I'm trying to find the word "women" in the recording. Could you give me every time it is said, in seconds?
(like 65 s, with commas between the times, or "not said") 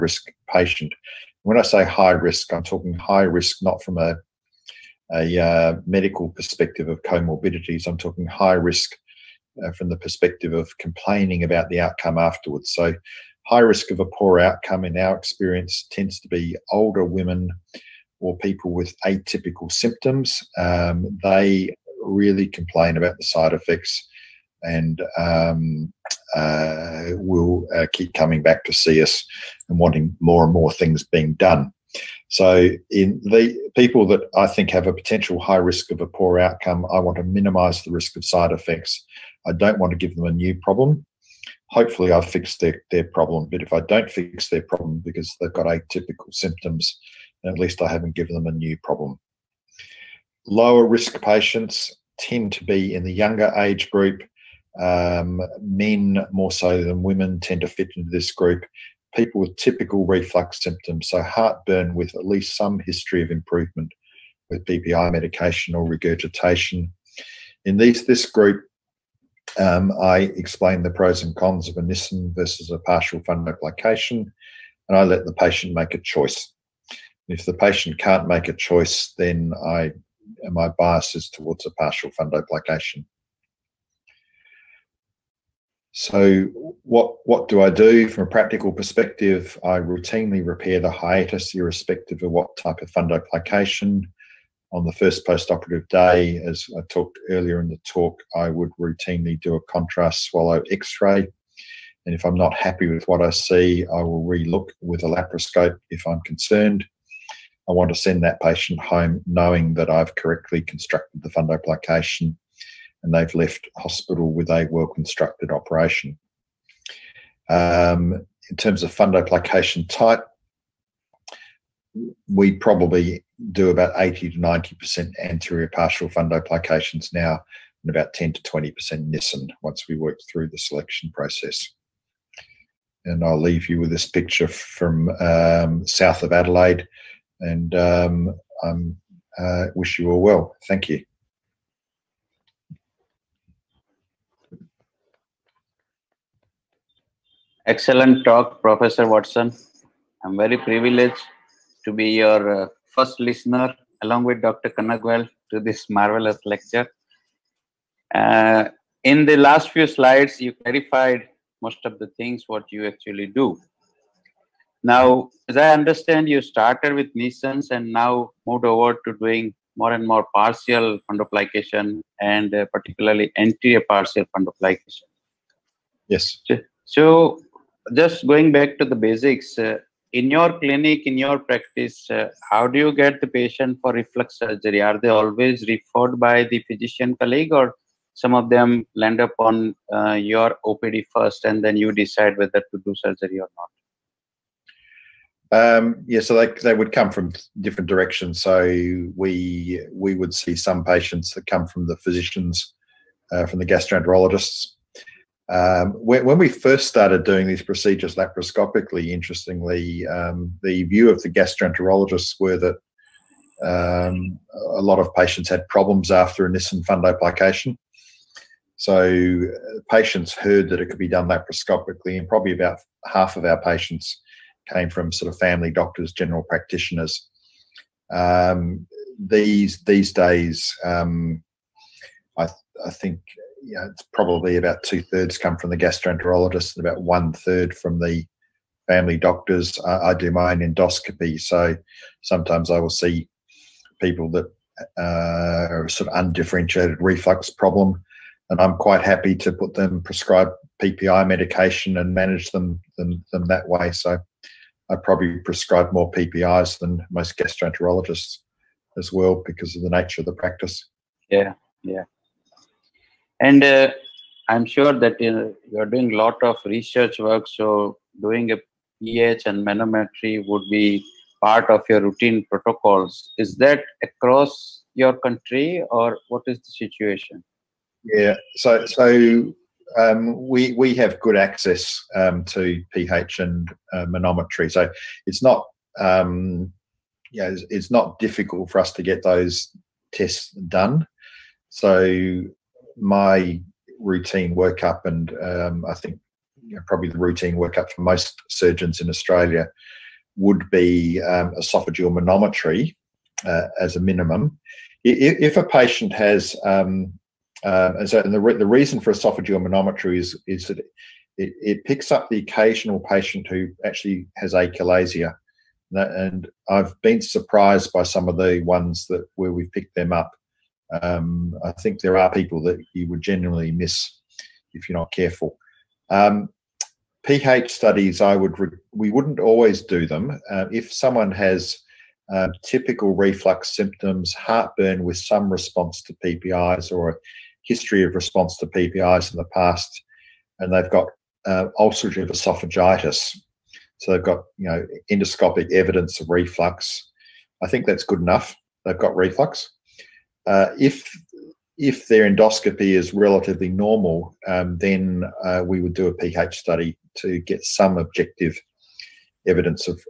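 17 s, 57 s.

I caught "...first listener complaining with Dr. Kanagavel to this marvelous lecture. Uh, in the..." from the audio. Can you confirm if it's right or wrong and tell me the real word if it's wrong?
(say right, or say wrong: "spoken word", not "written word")
wrong: "along", not "complaining".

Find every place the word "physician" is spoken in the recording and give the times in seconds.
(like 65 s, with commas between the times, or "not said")
186 s, 201 s.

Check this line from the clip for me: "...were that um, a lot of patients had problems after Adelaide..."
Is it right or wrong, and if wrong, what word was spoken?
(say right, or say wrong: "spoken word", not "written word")
wrong: "Nissen", not "Adelaide".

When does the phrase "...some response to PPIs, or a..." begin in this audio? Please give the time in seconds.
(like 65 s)
335 s.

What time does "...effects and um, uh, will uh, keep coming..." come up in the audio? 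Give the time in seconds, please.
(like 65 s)
23 s.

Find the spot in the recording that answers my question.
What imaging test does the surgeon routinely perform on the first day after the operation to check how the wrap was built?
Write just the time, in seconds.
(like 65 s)
99 s.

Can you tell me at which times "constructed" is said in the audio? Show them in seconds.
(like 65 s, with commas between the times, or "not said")
110 s, 114 s.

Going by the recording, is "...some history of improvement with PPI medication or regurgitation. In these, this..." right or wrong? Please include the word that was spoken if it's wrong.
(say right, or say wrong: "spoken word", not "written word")
right.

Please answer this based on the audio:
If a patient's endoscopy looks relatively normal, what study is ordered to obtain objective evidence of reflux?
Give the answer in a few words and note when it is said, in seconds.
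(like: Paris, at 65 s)
pH study, at 356 s.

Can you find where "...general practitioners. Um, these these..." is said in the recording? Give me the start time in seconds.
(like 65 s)
226 s.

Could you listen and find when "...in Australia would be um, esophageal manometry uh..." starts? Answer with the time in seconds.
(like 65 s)
298 s.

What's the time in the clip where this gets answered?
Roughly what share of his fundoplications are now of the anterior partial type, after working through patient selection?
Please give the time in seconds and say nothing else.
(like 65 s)
123 s.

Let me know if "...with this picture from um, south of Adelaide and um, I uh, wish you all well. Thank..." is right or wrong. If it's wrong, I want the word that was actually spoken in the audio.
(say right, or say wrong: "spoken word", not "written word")
right.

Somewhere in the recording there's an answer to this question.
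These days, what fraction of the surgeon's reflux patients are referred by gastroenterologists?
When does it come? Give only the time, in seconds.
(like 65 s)
234 s.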